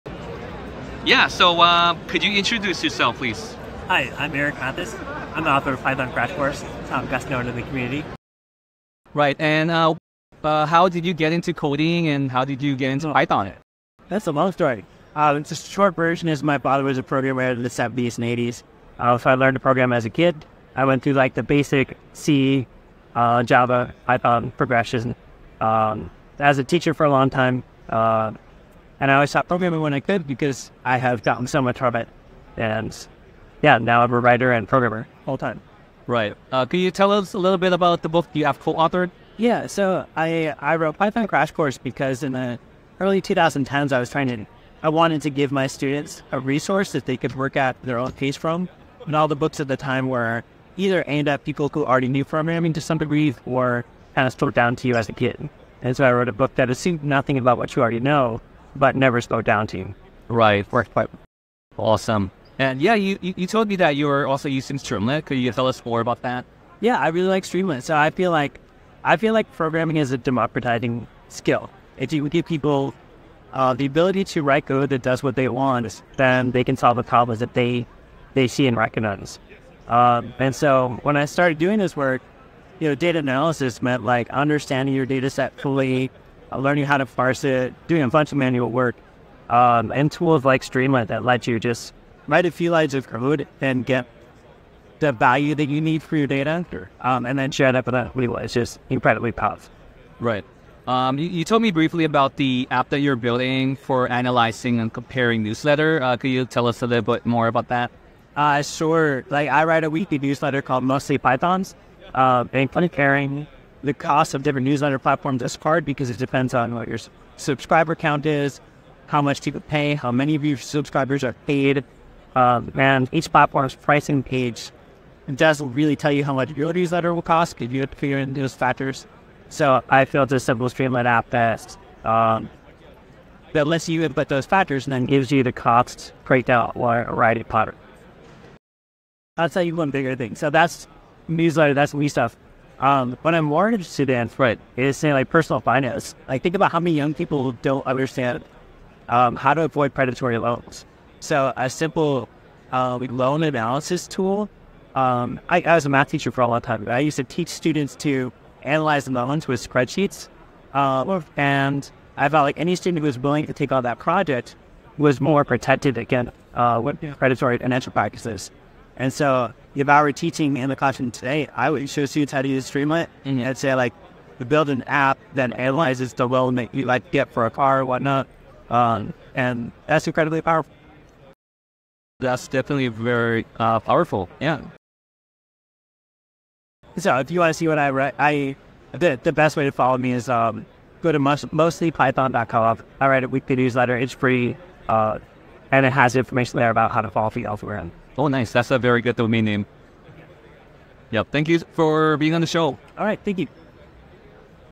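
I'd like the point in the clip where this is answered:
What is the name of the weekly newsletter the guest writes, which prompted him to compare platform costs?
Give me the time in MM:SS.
01:50.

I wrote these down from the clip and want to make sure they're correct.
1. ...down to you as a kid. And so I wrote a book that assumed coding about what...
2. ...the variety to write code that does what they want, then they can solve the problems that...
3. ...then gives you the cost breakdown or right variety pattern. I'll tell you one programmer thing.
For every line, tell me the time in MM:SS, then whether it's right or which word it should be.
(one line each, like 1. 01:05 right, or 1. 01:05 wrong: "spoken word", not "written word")
1. 00:54 wrong: "nothing", not "coding"
2. 01:13 wrong: "ability", not "variety"
3. 02:14 wrong: "bigger", not "programmer".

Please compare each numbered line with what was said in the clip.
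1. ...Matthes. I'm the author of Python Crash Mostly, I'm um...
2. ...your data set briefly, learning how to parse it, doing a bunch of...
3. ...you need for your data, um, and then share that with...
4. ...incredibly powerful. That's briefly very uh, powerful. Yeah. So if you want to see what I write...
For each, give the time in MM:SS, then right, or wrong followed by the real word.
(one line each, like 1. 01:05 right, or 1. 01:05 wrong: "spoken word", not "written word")
1. 00:04 wrong: "Course", not "Mostly"
2. 01:24 wrong: "fully", not "briefly"
3. 01:35 right
4. 03:00 wrong: "definitely", not "briefly".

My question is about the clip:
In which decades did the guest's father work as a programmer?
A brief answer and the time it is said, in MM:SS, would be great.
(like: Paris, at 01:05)
70s and 80s, at 00:17.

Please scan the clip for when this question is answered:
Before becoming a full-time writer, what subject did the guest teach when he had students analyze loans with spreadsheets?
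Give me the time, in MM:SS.
02:35.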